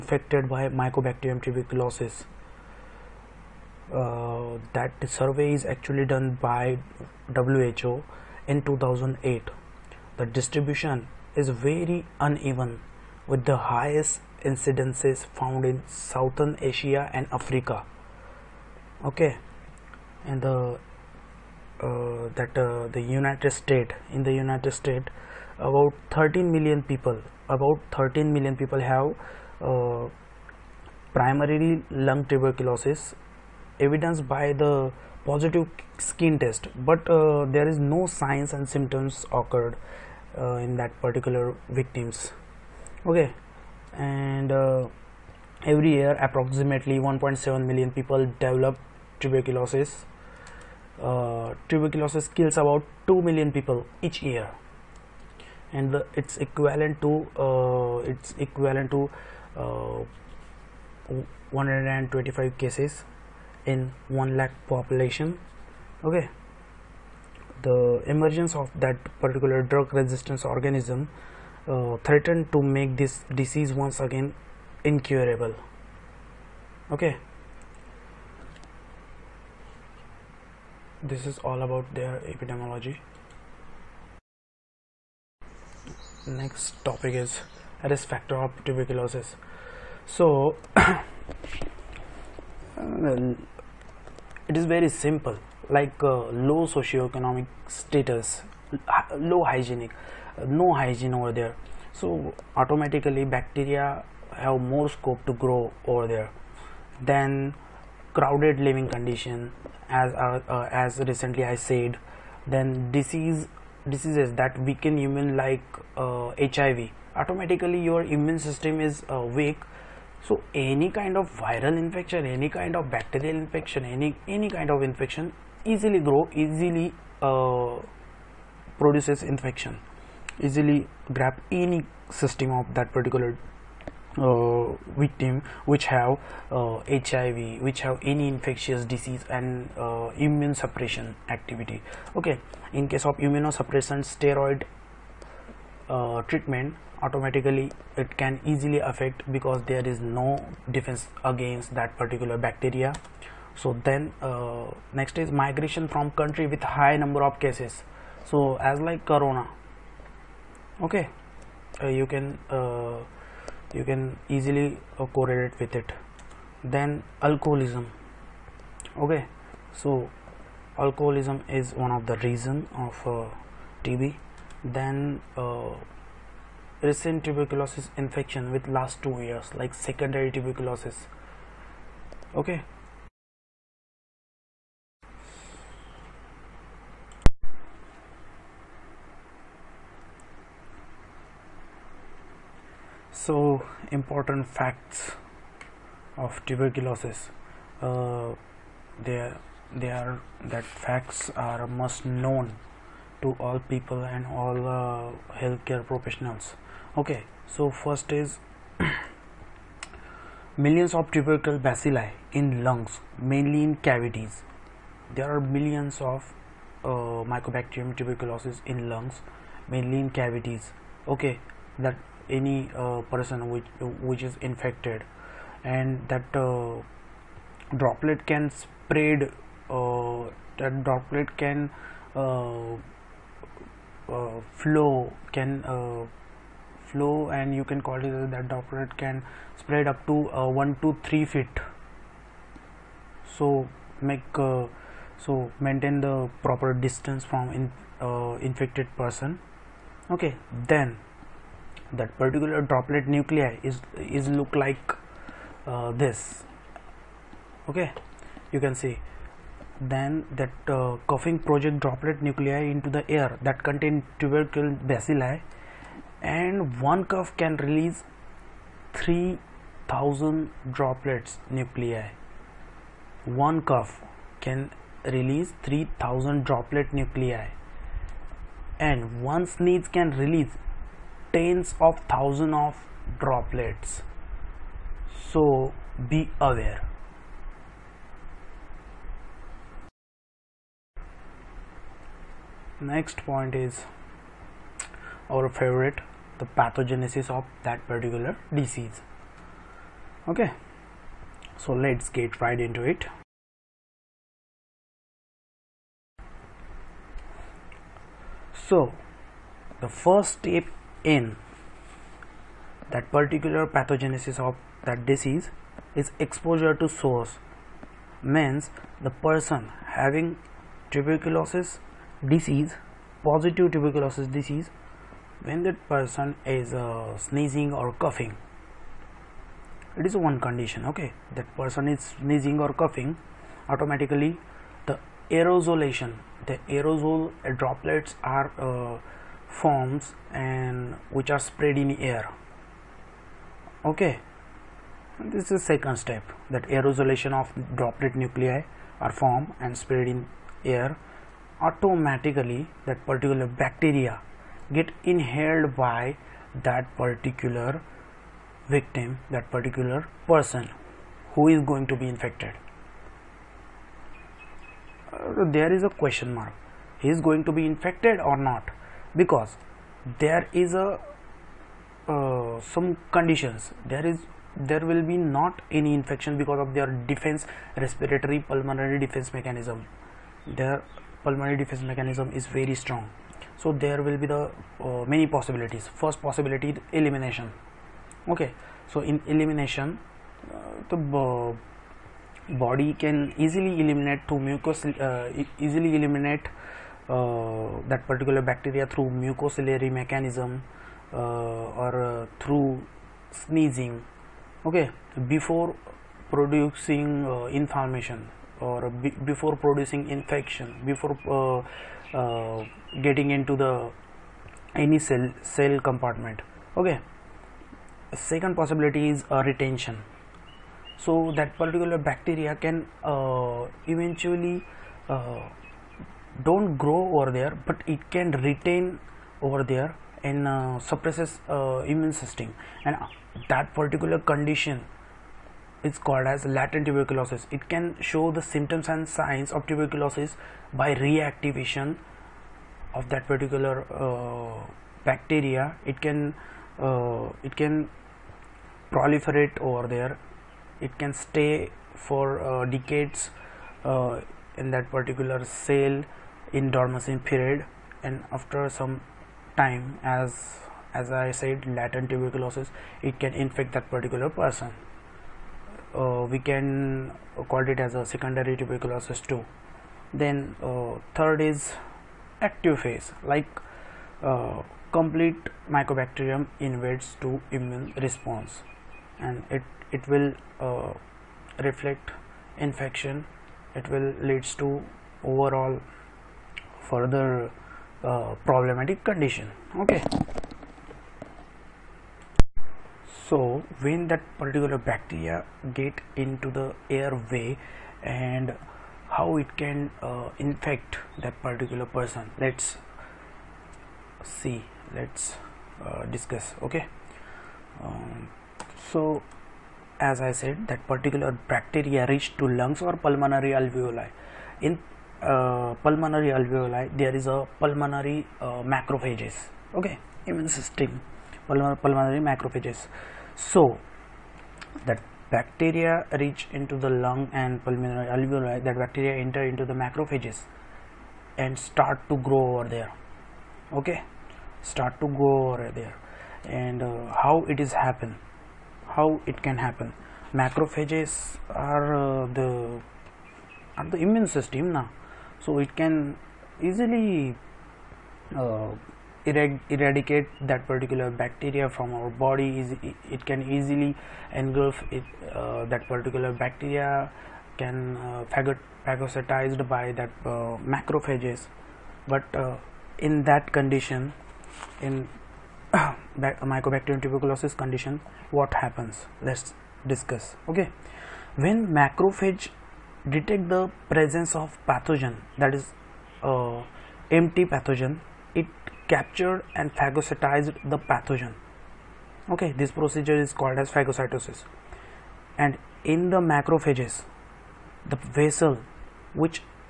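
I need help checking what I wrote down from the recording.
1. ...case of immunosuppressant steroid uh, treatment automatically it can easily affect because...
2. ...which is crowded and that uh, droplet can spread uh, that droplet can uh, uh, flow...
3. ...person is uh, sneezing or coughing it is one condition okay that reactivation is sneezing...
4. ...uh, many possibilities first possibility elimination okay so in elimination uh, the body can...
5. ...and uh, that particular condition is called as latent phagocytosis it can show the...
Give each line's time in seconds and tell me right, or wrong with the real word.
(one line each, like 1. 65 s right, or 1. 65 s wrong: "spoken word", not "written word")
1. 142 s right
2. 224 s wrong: "infected", not "crowded"
3. 325 s wrong: "person", not "reactivation"
4. 384 s right
5. 432 s wrong: "tuberculosis", not "phagocytosis".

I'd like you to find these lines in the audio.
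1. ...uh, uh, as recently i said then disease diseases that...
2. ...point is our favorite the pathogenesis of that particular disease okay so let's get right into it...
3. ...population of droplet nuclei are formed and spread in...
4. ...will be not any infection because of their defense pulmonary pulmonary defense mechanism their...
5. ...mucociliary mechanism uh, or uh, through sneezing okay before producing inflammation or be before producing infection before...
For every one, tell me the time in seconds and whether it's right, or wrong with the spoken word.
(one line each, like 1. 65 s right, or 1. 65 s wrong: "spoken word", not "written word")
1. 110 s right
2. 293 s right
3. 346 s wrong: "aerosolation", not "population"
4. 374 s wrong: "respiratory", not "pulmonary"
5. 399 s right.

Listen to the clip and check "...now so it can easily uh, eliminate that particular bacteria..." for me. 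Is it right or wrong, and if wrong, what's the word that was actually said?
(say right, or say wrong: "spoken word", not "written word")
wrong: "eradicate", not "eliminate".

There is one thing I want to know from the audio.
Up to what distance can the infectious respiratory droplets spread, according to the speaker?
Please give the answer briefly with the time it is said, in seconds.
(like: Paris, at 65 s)
1 to 3 feet, at 240 s.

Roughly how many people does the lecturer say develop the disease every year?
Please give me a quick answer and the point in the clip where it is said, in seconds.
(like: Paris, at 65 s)
1.7 million, at 46 s.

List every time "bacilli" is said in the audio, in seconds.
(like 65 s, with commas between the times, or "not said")
211 s, 264 s.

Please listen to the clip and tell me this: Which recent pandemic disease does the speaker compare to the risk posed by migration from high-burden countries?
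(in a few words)
corona.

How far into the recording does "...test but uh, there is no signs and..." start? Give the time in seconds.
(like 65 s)
36 s.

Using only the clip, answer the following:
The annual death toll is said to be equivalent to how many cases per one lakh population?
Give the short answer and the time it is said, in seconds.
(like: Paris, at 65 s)
125, at 61 s.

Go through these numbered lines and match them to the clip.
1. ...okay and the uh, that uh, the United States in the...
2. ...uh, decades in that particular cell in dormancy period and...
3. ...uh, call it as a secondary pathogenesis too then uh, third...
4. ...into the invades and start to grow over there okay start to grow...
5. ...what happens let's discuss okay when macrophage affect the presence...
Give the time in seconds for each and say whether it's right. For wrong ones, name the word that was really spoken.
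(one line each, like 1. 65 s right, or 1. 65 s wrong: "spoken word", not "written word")
1. 19 s right
2. 452 s right
3. 467 s wrong: "tuberculosis", not "pathogenesis"
4. 529 s wrong: "macrophages", not "invades"
5. 568 s wrong: "detect", not "affect".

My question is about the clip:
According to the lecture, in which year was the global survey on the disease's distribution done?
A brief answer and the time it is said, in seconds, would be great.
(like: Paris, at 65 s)
2008, at 8 s.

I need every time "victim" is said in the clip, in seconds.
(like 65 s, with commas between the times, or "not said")
41 s, 134 s, 358 s.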